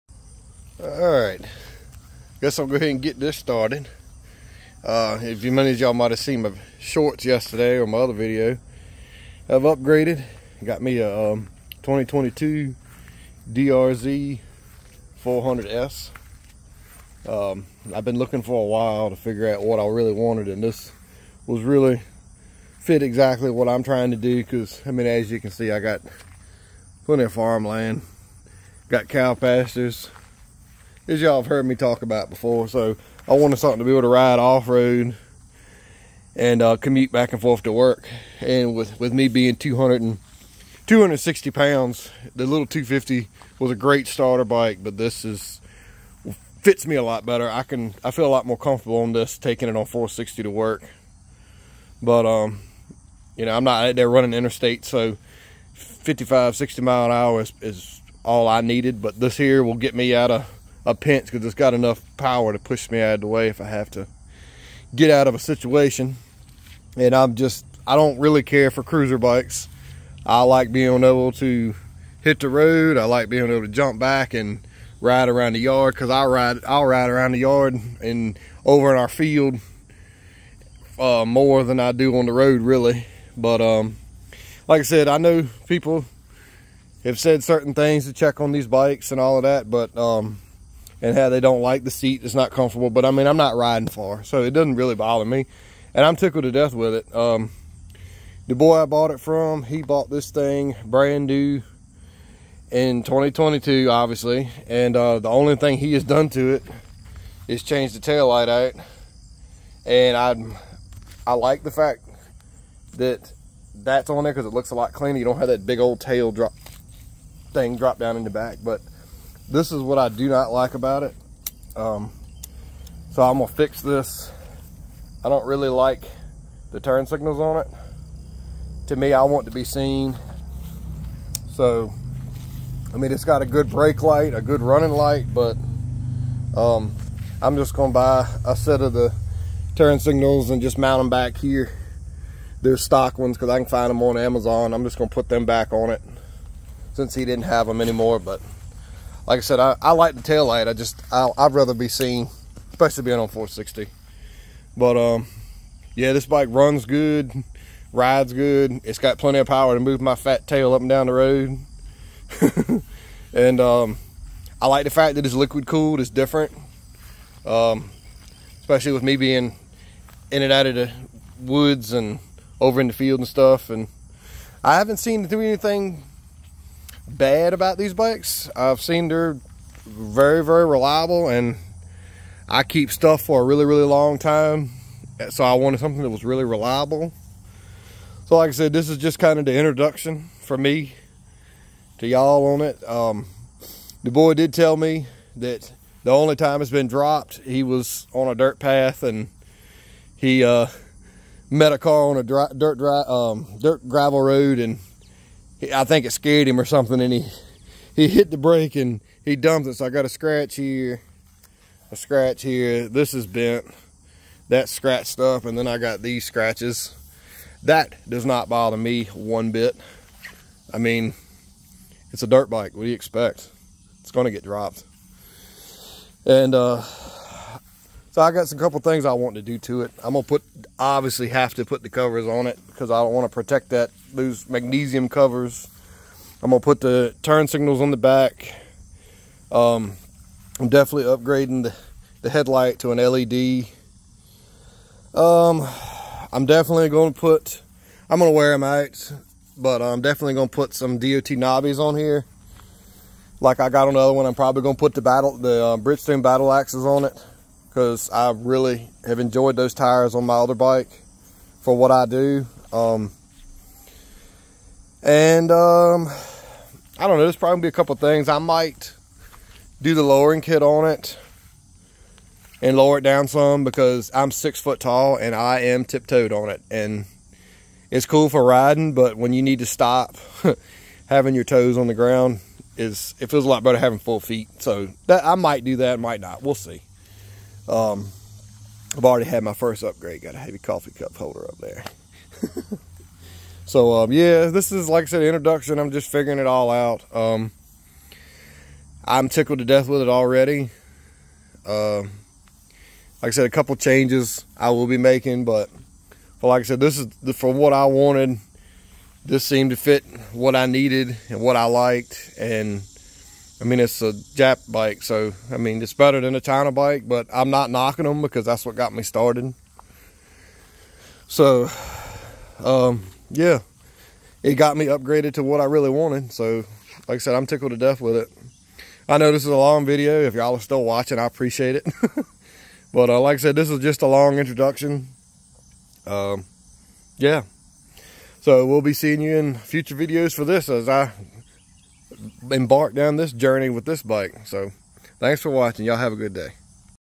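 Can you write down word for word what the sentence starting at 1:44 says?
And uh, the only thing he has done to it is change the tail light out.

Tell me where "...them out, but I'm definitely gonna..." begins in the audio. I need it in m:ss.
4:08.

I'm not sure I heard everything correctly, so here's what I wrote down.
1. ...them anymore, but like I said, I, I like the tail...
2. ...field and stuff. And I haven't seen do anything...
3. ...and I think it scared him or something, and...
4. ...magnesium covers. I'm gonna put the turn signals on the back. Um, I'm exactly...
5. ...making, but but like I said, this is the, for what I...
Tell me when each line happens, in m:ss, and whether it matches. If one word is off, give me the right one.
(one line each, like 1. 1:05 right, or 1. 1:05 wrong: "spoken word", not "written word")
1. 2:27 right
2. 2:52 right
3. 3:24 right
4. 3:54 wrong: "definitely", not "exactly"
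5. 5:04 right.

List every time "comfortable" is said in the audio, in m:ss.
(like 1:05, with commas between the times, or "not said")
0:48, 1:32.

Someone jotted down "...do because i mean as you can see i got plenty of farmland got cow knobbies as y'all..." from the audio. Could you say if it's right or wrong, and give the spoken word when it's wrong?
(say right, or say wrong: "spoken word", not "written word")
wrong: "pastures", not "knobbies".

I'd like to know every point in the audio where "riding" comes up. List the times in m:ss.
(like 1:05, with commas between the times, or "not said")
1:33, 4:38.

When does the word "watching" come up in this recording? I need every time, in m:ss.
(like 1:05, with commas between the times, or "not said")
5:30, 5:45.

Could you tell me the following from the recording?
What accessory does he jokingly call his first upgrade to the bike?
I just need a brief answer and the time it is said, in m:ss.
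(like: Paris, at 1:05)
Coffee cup holder, at 4:50.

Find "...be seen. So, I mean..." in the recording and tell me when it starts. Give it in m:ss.
2:09.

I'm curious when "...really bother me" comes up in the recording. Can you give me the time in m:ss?
1:34.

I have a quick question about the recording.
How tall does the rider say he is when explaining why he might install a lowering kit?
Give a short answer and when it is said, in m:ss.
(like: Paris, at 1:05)
6 feet, at 4:34.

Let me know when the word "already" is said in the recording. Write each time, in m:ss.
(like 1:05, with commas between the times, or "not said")
4:49, 5:00.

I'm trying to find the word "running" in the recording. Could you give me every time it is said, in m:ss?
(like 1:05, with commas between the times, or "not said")
0:54, 2:14.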